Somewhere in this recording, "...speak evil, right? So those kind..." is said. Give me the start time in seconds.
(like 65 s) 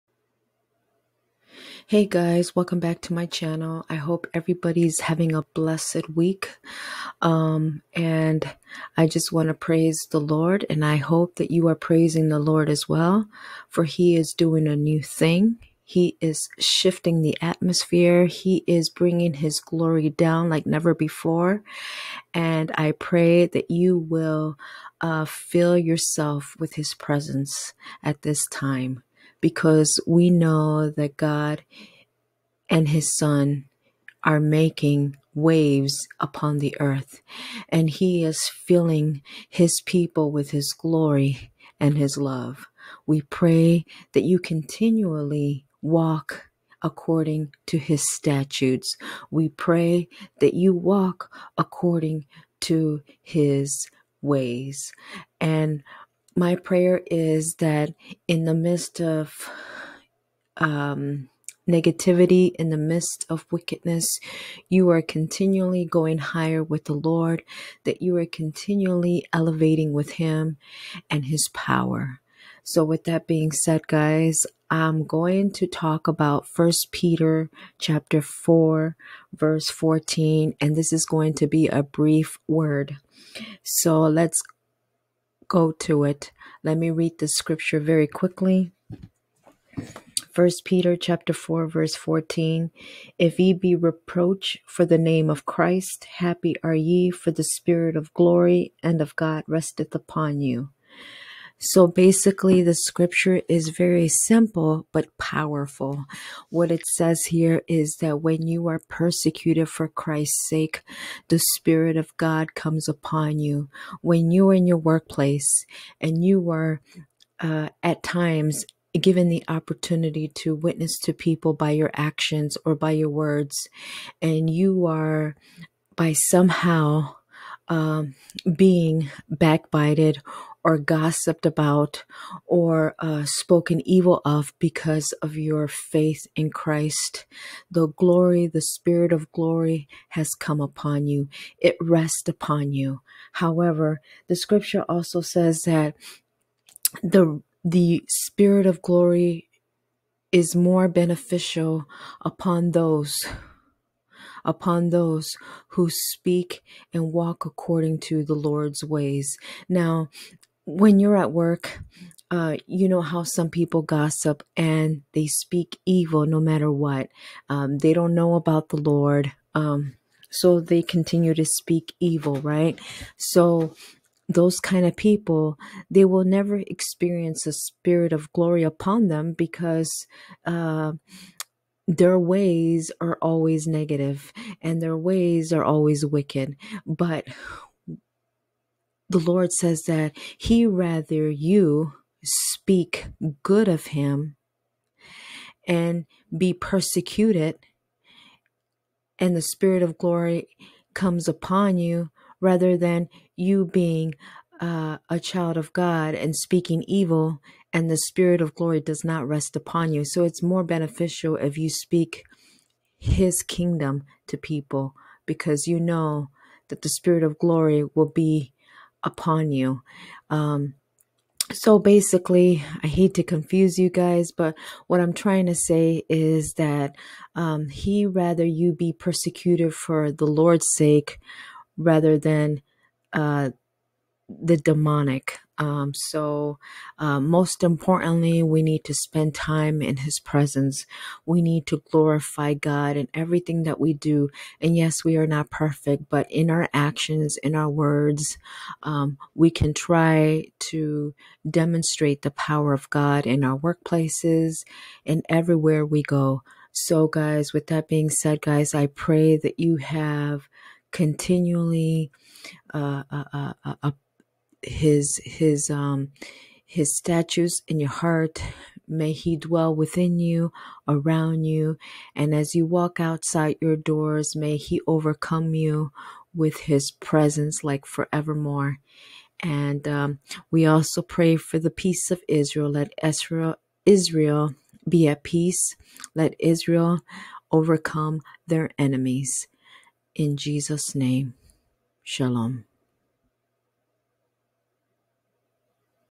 171 s.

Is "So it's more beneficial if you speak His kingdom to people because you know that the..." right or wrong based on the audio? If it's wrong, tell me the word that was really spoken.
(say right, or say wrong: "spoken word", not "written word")
right.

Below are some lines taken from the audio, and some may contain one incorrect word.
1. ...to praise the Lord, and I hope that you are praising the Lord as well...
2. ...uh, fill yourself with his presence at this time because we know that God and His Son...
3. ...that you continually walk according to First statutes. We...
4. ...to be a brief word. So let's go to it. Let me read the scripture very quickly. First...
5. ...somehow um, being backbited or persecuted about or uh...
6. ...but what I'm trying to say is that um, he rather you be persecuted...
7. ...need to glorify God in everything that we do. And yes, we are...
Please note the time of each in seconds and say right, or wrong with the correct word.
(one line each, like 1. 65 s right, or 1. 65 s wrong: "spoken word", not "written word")
1. 9 s right
2. 25 s right
3. 44 s wrong: "His", not "First"
4. 81 s right
5. 126 s wrong: "gossiped", not "persecuted"
6. 224 s right
7. 241 s right.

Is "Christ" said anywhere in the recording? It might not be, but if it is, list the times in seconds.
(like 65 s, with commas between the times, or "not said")
95 s, 109 s, 136 s.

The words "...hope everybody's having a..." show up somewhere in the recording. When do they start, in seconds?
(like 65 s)
3 s.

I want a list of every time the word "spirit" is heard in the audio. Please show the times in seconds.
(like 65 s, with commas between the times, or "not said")
97 s, 111 s, 138 s, 148 s, 177 s, 199 s, 207 s, 216 s.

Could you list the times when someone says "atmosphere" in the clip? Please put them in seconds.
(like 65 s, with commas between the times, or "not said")
17 s.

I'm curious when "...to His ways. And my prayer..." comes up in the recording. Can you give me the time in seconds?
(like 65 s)
52 s.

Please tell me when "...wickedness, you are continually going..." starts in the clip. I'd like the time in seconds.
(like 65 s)
63 s.